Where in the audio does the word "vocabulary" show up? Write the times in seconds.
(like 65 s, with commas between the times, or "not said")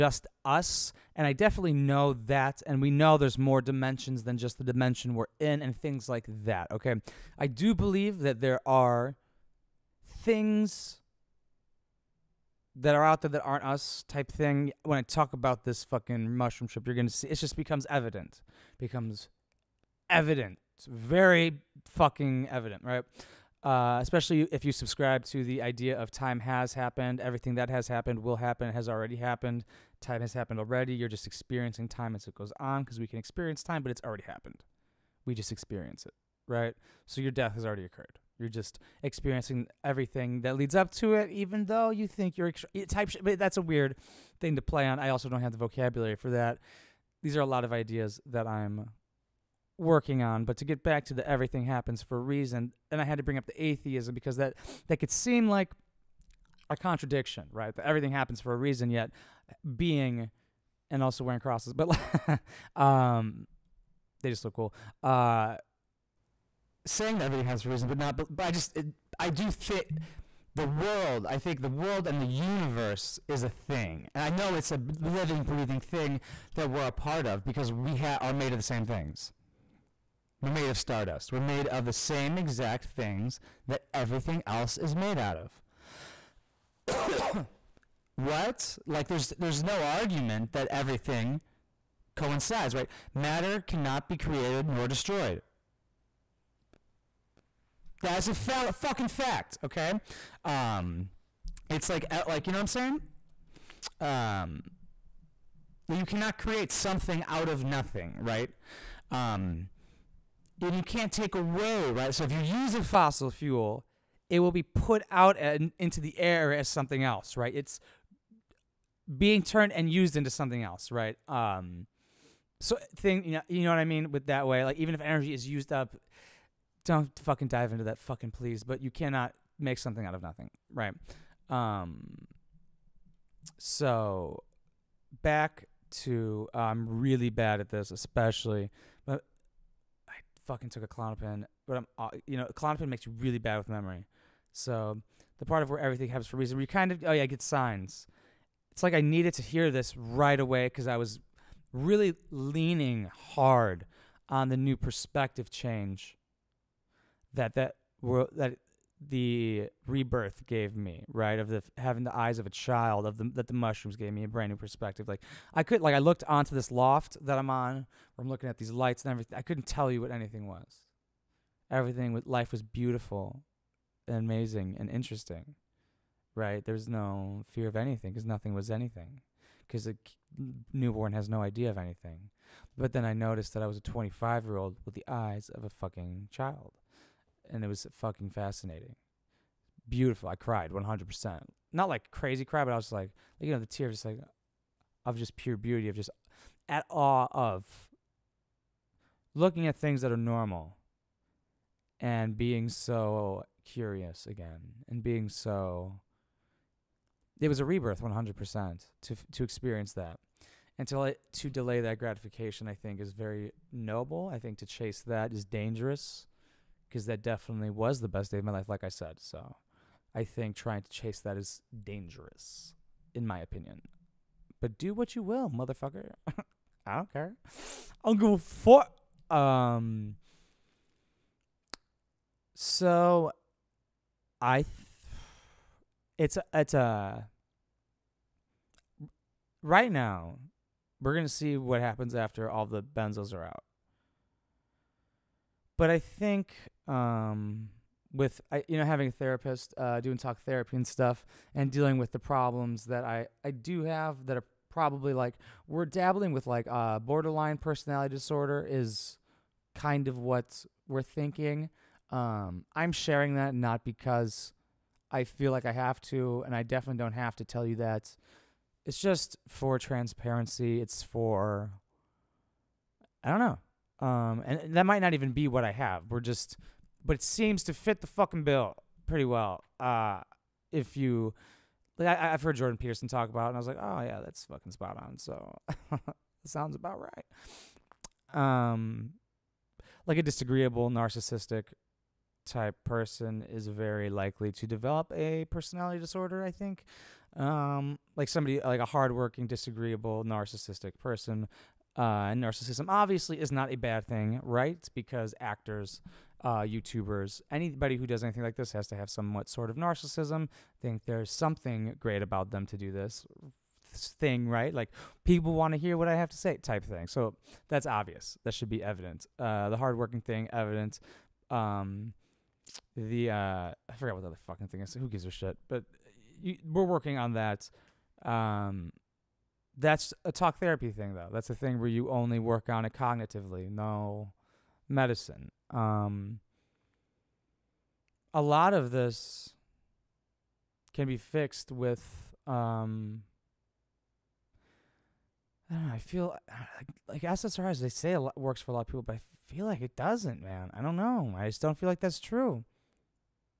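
45 s.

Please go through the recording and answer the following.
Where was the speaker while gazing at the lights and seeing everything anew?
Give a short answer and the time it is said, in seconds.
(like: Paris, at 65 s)
loft, at 166 s.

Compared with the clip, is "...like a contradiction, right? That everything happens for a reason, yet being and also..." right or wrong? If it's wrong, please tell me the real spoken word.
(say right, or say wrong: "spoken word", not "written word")
right.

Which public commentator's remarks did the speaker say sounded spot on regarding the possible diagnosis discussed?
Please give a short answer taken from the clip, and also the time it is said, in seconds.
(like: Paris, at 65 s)
Jordan Peterson, at 282 s.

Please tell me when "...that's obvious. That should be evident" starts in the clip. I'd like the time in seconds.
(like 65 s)
317 s.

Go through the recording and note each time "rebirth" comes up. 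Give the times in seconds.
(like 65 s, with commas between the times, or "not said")
159 s, 207 s.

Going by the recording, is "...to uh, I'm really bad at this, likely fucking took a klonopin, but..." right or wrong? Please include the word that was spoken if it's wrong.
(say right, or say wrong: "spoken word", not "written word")
wrong: "especially", not "likely".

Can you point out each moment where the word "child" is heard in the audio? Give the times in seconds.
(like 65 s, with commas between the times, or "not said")
162 s, 186 s.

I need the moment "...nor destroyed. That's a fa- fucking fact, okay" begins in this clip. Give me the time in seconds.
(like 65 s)
94 s.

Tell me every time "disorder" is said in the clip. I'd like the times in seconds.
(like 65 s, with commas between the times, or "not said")
258 s, 296 s.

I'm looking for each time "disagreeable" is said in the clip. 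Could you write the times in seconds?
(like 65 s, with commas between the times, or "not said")
290 s, 299 s.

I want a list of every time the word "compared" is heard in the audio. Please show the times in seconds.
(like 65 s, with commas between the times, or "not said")
not said.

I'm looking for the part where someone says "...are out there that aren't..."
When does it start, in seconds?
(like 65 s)
12 s.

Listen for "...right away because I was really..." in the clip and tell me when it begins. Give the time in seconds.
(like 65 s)
149 s.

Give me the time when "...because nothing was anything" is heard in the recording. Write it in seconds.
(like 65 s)
178 s.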